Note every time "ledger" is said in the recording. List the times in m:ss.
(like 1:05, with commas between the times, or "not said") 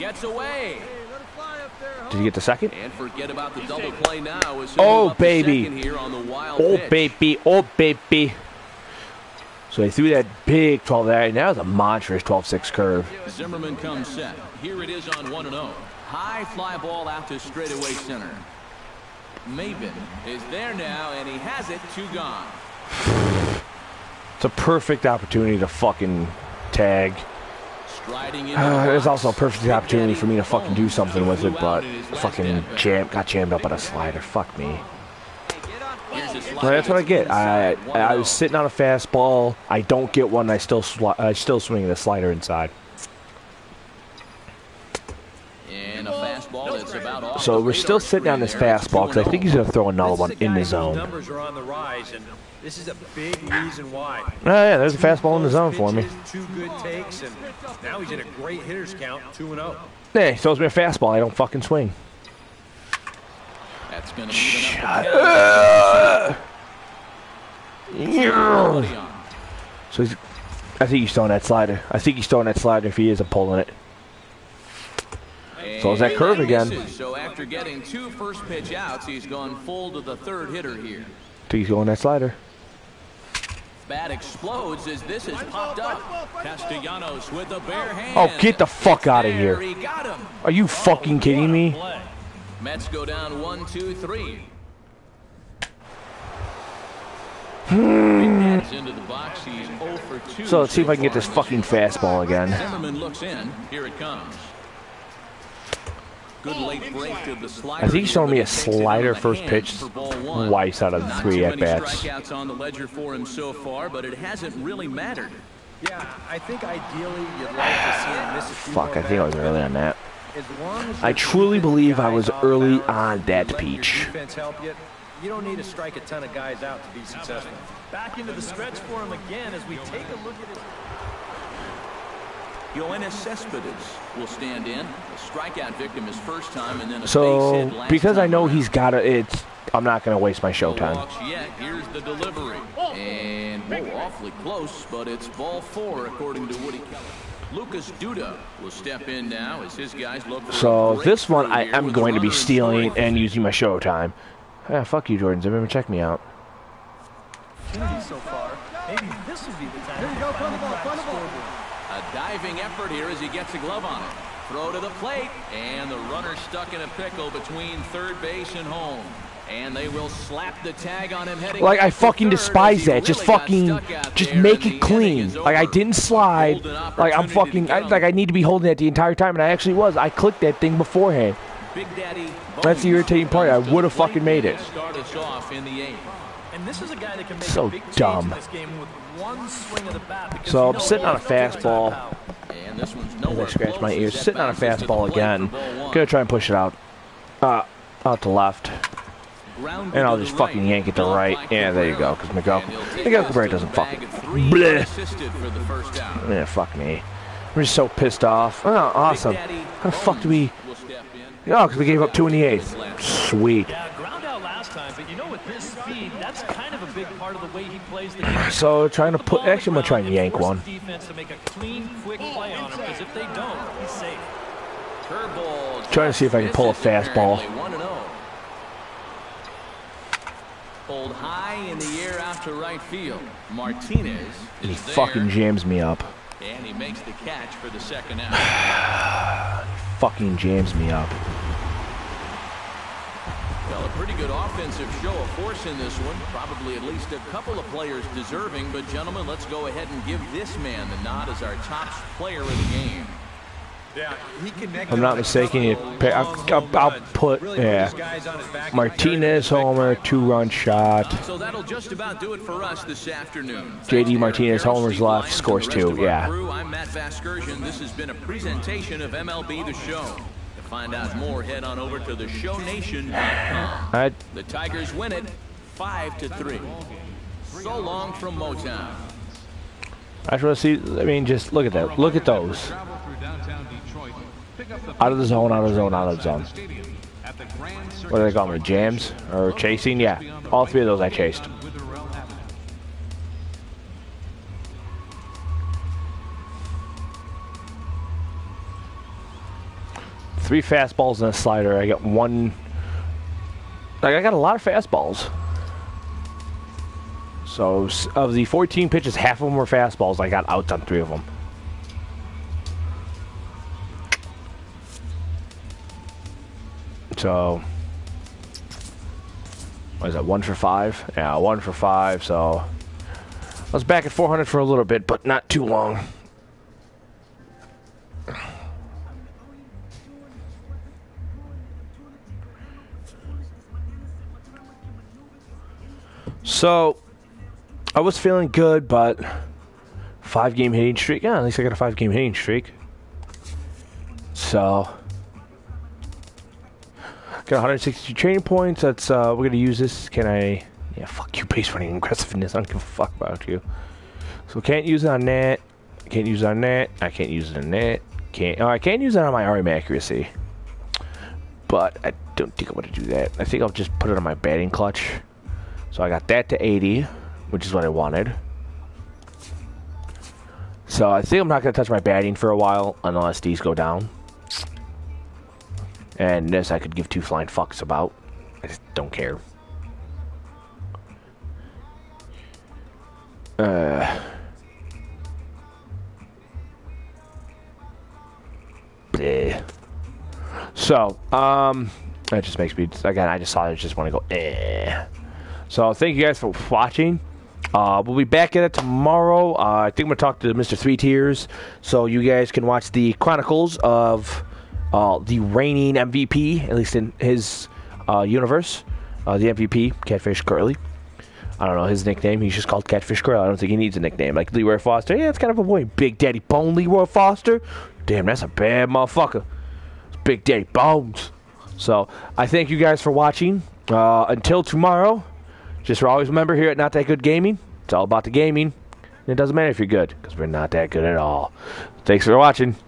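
1:52.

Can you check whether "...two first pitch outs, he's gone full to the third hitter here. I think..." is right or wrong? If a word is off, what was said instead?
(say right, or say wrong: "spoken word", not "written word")
right.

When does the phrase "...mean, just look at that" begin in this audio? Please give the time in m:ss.
4:41.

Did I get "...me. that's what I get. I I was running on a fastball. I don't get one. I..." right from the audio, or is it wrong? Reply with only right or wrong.
wrong.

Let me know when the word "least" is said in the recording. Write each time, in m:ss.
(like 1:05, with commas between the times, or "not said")
4:06, 5:41, 6:46.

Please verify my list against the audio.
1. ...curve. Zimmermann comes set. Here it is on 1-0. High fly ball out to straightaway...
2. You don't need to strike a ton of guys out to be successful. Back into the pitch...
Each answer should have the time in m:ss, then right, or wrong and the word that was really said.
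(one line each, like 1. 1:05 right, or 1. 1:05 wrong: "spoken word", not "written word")
1. 0:12 right
2. 2:05 wrong: "stretch", not "pitch".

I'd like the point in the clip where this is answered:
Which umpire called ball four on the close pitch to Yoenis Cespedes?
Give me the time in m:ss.
2:26.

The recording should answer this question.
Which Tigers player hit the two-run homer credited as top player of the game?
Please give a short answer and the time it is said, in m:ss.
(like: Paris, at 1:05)
JD Martinez, at 4:23.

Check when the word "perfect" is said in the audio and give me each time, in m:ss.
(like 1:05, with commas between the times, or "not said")
0:24, 0:29.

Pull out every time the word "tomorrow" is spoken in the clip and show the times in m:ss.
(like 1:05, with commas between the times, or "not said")
6:38, 7:04.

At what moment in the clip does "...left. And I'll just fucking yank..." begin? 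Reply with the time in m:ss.
3:18.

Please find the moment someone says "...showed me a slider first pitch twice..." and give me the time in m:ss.
1:48.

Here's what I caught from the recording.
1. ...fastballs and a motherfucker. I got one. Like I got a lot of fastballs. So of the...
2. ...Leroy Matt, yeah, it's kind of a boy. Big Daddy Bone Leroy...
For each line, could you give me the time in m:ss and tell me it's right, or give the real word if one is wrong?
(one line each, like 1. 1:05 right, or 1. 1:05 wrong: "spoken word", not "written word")
1. 5:00 wrong: "slider", not "motherfucker"
2. 6:54 wrong: "Foster", not "Matt".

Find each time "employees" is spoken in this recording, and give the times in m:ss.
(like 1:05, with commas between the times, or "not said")
not said.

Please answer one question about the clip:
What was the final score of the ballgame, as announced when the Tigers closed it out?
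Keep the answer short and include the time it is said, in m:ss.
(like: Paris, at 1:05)
5 to 3, at 4:35.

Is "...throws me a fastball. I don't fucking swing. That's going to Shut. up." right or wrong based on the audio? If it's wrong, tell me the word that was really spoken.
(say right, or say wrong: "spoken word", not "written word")
right.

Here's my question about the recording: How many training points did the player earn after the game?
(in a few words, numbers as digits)
162.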